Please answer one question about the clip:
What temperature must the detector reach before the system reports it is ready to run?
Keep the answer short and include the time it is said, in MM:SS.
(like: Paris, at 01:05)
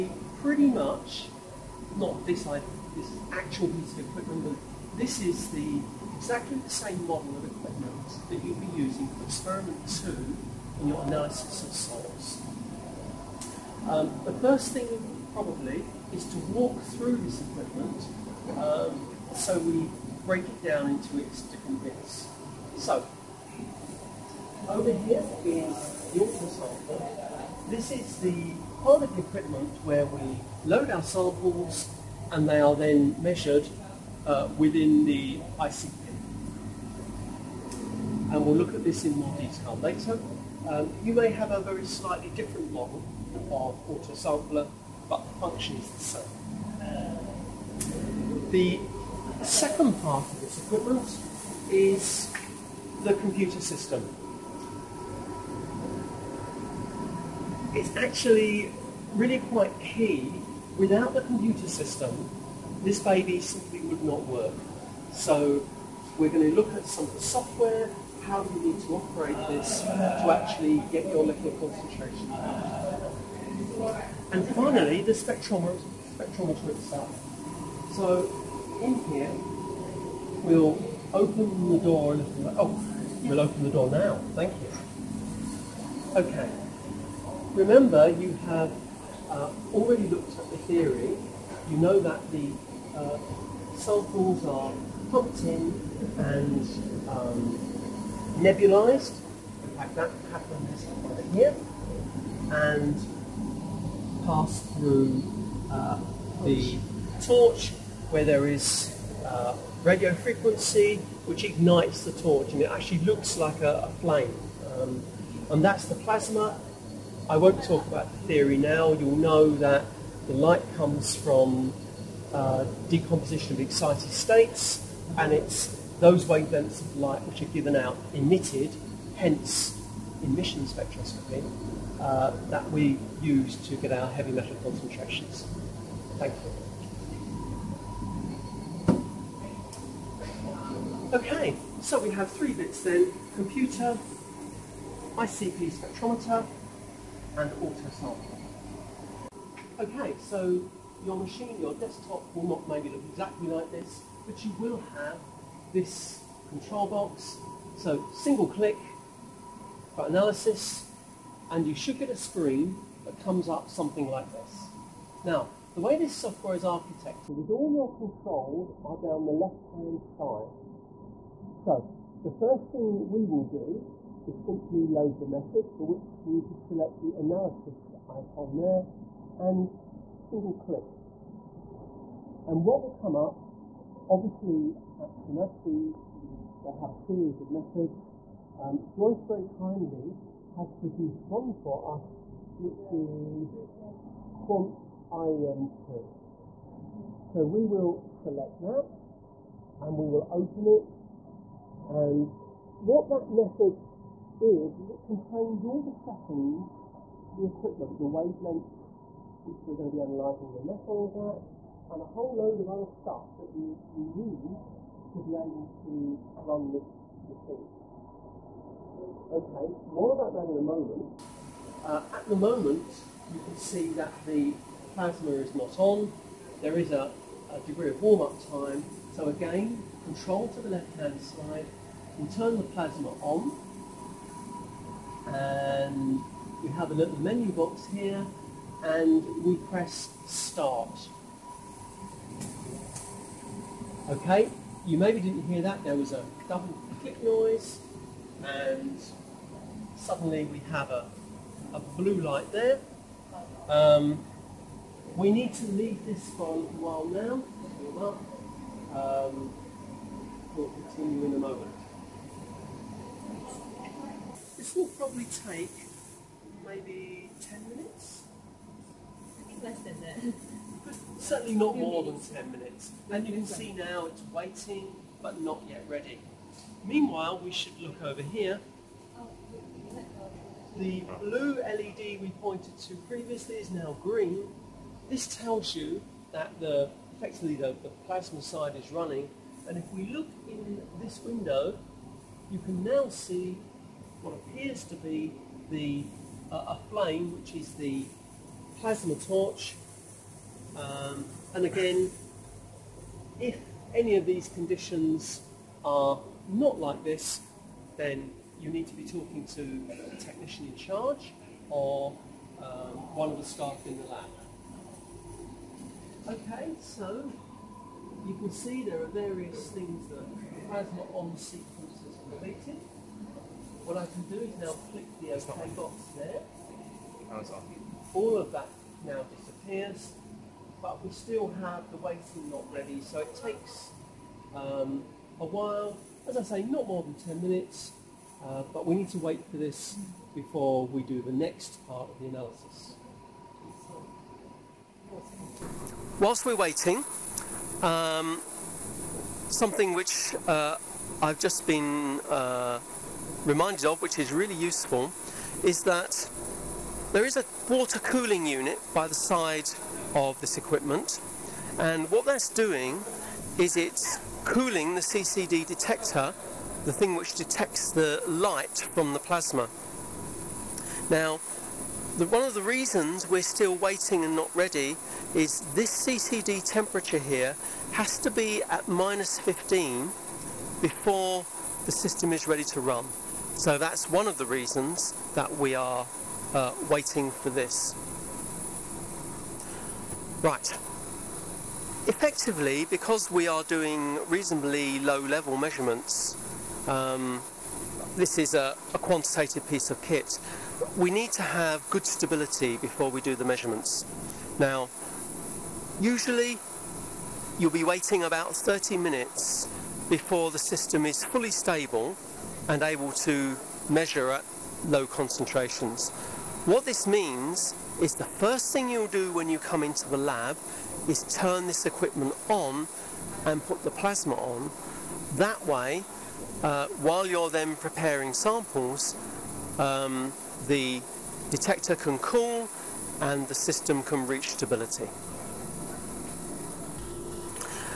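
-15, at 06:18.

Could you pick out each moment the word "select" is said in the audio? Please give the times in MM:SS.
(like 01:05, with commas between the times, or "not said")
02:56, 03:18.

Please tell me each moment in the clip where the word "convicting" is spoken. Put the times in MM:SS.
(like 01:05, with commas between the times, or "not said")
not said.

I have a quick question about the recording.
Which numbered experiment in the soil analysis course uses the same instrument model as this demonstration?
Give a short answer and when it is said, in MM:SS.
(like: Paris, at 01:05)
Experiment 2, at 00:09.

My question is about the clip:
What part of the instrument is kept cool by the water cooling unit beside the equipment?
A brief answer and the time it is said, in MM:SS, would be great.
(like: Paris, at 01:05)
CCD detector, at 06:05.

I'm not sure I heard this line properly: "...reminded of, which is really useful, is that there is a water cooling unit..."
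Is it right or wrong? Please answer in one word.
right.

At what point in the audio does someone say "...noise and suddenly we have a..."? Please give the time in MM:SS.
04:07.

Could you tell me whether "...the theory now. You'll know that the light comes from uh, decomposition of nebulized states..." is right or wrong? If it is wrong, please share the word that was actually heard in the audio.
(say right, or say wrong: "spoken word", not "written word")
wrong: "excited", not "nebulized".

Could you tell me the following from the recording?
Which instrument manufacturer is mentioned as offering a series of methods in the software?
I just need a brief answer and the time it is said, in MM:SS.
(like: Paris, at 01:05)
Shimadzu, at 03:05.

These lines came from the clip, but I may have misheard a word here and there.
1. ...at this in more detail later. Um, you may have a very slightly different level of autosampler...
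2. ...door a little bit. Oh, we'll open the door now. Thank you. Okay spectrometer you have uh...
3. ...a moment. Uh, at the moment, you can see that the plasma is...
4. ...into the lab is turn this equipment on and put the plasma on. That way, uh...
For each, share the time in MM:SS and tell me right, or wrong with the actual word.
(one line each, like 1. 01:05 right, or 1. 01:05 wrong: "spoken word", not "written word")
1. 00:38 wrong: "model", not "level"
2. 01:21 wrong: "remember", not "spectrometer"
3. 03:40 right
4. 06:59 right.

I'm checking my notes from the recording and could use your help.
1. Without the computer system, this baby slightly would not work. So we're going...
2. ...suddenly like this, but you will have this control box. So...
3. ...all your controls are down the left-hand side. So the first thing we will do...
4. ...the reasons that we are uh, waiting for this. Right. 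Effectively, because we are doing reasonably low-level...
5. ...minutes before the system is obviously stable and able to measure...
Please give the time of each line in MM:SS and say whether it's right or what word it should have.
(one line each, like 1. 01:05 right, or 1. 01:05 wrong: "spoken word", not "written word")
1. 01:00 wrong: "simply", not "slightly"
2. 02:33 wrong: "exactly", not "suddenly"
3. 02:47 right
4. 06:24 right
5. 06:48 wrong: "fully", not "obviously".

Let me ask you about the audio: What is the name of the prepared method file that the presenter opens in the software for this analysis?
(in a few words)
quant IEM2.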